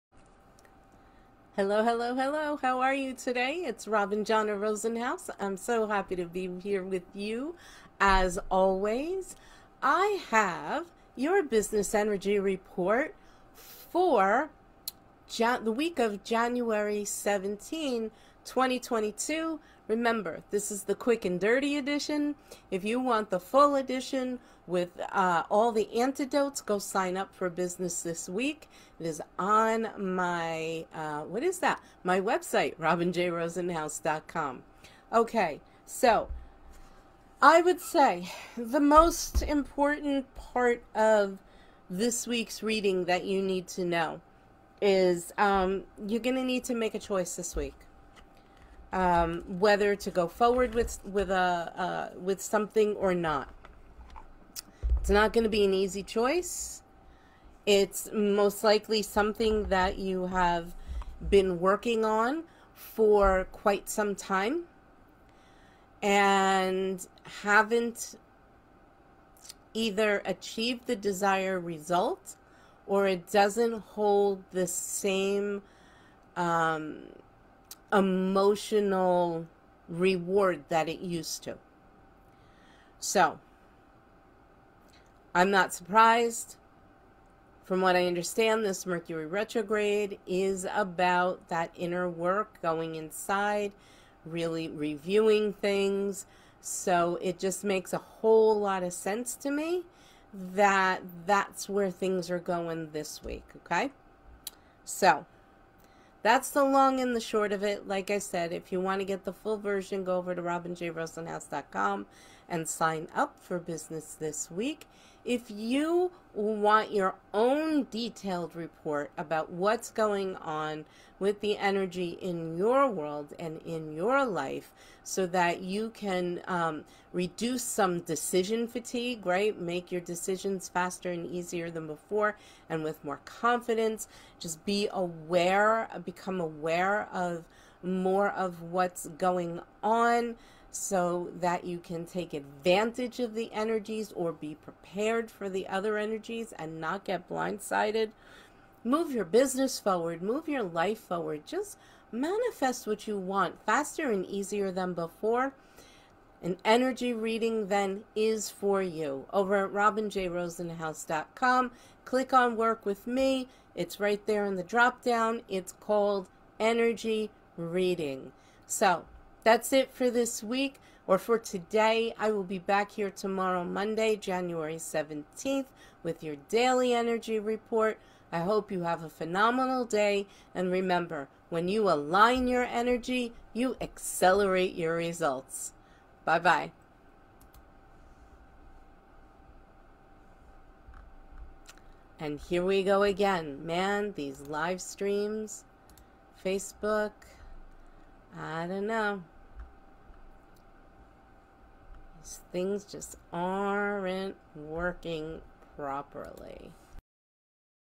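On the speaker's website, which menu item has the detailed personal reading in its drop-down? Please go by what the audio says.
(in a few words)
Work with Me.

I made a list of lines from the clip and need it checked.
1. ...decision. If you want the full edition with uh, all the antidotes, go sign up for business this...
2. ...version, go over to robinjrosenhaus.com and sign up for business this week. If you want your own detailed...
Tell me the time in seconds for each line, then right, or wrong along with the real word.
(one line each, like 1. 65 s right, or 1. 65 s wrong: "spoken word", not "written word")
1. 21 s wrong: "edition", not "decision"
2. 109 s right.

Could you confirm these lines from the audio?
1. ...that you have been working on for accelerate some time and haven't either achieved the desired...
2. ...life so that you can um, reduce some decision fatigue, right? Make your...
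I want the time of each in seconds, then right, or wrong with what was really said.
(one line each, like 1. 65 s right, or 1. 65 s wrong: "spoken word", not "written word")
1. 59 s wrong: "quite", not "accelerate"
2. 124 s right.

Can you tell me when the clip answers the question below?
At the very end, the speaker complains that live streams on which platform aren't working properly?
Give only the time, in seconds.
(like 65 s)
196 s.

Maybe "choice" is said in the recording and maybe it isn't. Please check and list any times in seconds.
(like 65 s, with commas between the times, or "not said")
46 s, 56 s.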